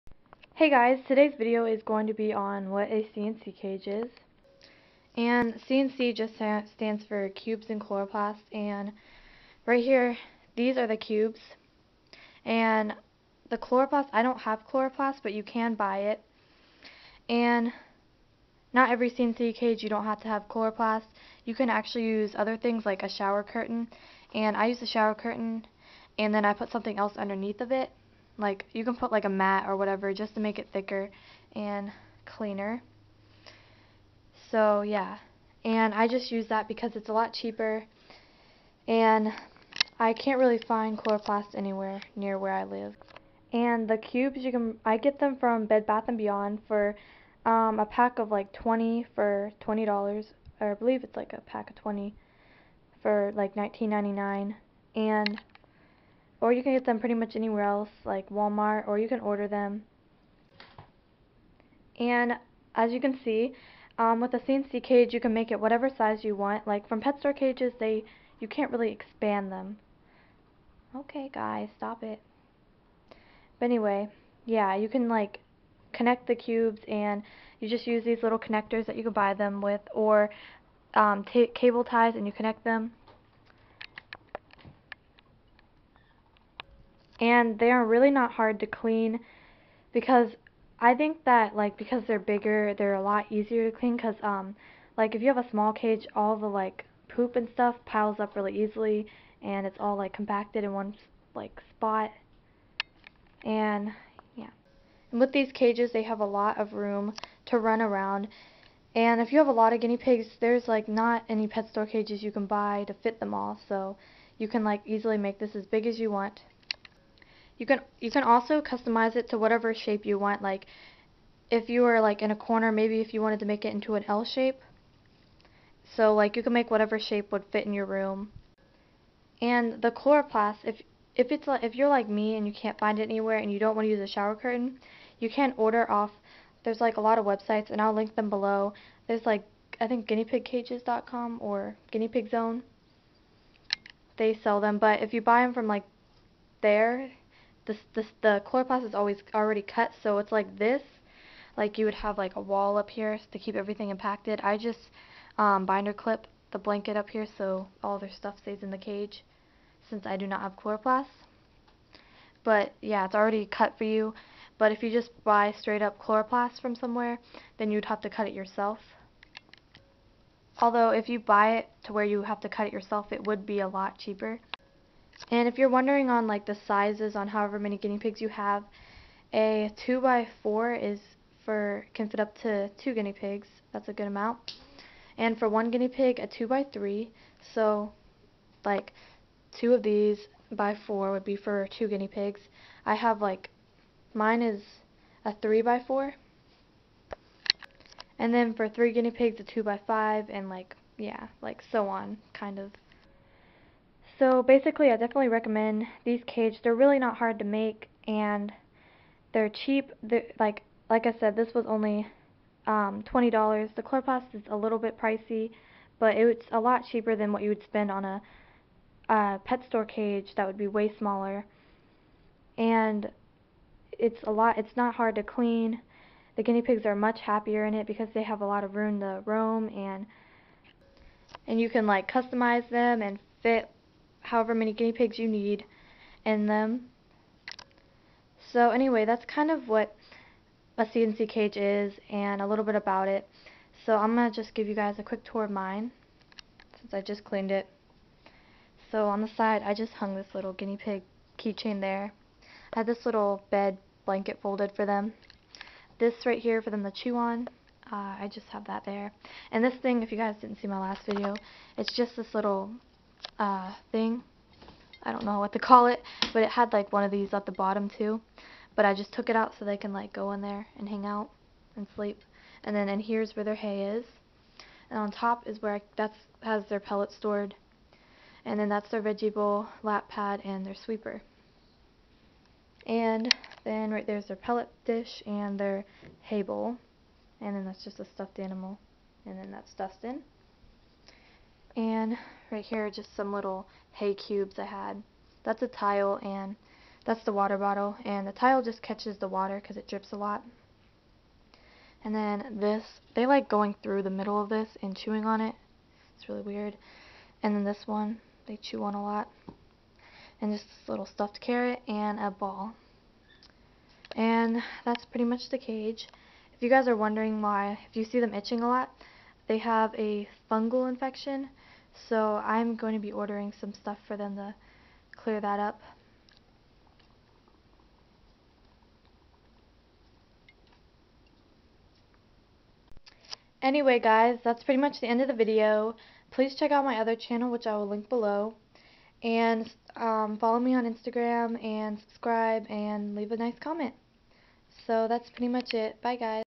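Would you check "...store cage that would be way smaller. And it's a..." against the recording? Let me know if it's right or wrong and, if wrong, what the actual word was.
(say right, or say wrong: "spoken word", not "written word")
right.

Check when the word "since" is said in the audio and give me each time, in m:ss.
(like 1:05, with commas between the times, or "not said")
2:39, 4:06.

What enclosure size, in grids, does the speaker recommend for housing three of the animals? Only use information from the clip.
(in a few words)
2 by 5.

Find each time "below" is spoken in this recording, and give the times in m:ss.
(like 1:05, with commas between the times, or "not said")
2:18, 5:38.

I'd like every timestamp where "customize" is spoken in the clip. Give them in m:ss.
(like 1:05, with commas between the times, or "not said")
1:58, 3:52.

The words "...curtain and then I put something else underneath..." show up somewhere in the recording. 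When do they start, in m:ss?
0:25.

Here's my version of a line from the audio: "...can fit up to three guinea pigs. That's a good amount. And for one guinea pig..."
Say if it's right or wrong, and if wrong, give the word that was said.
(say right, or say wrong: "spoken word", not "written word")
wrong: "two", not "three".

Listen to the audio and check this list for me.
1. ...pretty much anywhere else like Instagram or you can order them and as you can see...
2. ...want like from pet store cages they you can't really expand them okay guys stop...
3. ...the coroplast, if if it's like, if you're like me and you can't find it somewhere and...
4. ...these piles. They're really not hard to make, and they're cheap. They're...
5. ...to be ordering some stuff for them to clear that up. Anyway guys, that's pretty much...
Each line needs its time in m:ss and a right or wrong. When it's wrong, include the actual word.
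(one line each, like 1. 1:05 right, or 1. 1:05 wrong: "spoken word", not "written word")
1. 0:56 wrong: "Walmart", not "Instagram"
2. 1:06 right
3. 2:09 wrong: "anywhere", not "somewhere"
4. 3:26 wrong: "cages", not "piles"
5. 5:22 right.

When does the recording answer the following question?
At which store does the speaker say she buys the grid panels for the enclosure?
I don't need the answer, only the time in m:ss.
0:45.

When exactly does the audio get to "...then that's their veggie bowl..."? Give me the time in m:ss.
4:38.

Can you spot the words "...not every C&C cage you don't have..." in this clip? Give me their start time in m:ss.
0:18.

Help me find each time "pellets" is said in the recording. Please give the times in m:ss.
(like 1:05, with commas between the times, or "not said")
4:36, 4:44.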